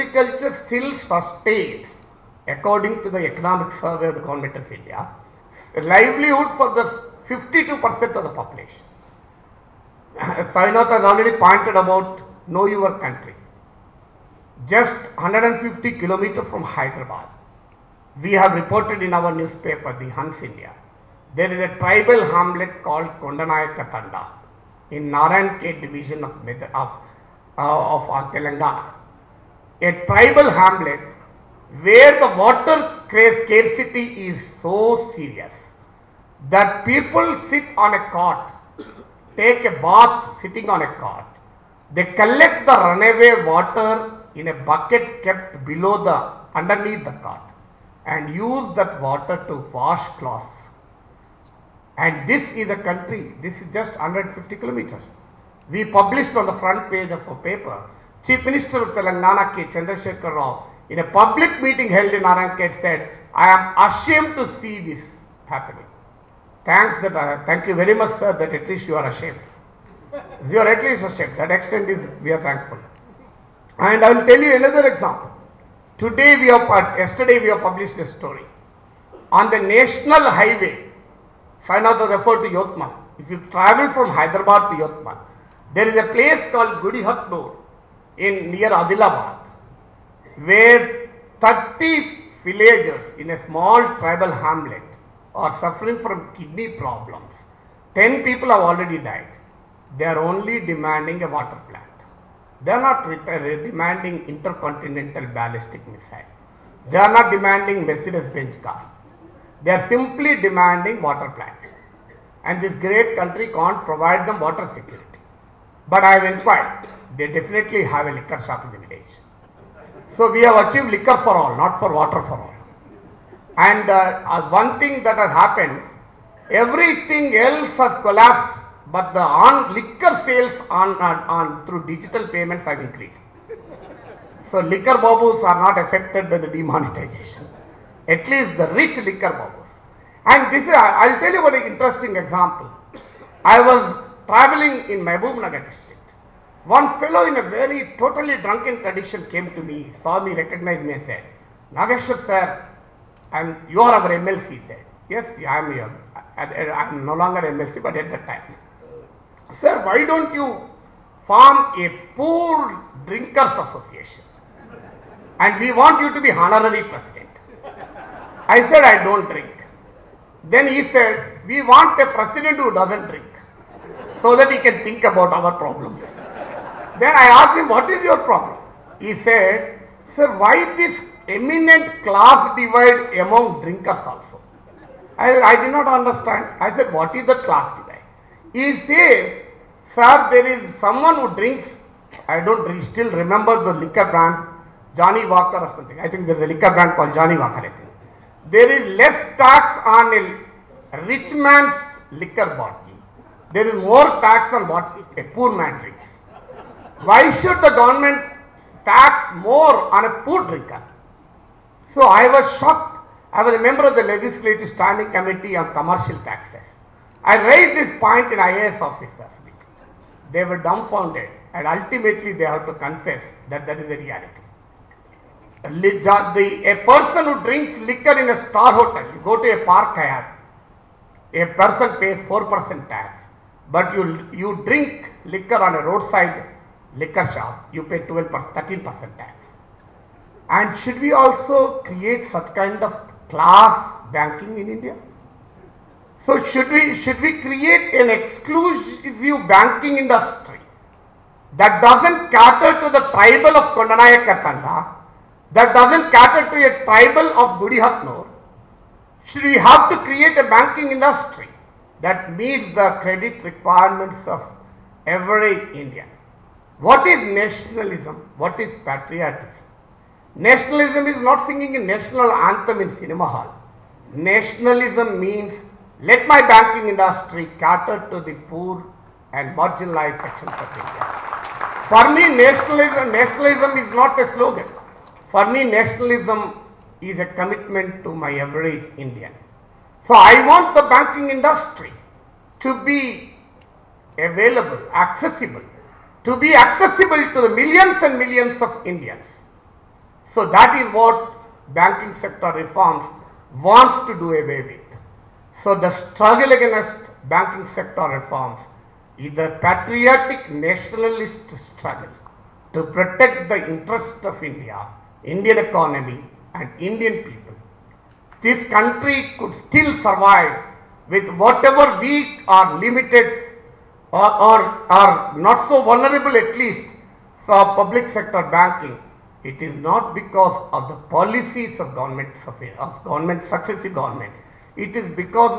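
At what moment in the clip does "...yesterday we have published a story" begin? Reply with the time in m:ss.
1:16.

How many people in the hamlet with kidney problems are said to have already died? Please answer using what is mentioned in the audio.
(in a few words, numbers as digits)
10.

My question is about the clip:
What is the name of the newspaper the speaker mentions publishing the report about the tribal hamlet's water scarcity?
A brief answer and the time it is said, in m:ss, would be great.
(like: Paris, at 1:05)
The Hans India, at 0:20.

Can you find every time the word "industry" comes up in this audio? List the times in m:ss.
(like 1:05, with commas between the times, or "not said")
4:09, 4:20, 4:36, 4:51.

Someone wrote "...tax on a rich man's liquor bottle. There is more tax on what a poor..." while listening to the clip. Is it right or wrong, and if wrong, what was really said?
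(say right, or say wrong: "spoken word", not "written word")
right.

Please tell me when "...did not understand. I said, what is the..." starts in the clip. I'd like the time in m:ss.
3:05.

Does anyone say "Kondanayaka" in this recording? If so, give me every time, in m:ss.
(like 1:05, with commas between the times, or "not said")
0:23, 4:13.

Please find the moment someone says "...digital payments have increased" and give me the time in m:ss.
2:11.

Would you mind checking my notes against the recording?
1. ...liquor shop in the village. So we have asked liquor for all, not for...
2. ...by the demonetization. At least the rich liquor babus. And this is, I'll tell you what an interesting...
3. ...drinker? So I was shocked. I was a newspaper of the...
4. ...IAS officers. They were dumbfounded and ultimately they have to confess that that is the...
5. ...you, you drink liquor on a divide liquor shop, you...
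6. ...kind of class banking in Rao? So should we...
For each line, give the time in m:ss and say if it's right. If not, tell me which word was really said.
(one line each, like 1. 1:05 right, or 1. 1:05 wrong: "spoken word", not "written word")
1. 1:58 wrong: "achieved", not "asked"
2. 2:16 right
3. 3:30 wrong: "member", not "newspaper"
4. 3:38 right
5. 3:53 wrong: "roadside", not "divide"
6. 4:02 wrong: "India", not "Rao".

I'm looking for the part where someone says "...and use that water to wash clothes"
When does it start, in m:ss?
0:48.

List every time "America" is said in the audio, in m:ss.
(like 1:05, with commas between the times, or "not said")
not said.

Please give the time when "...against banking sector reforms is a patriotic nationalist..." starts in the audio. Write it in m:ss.
5:06.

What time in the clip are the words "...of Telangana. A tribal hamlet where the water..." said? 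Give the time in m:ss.
0:27.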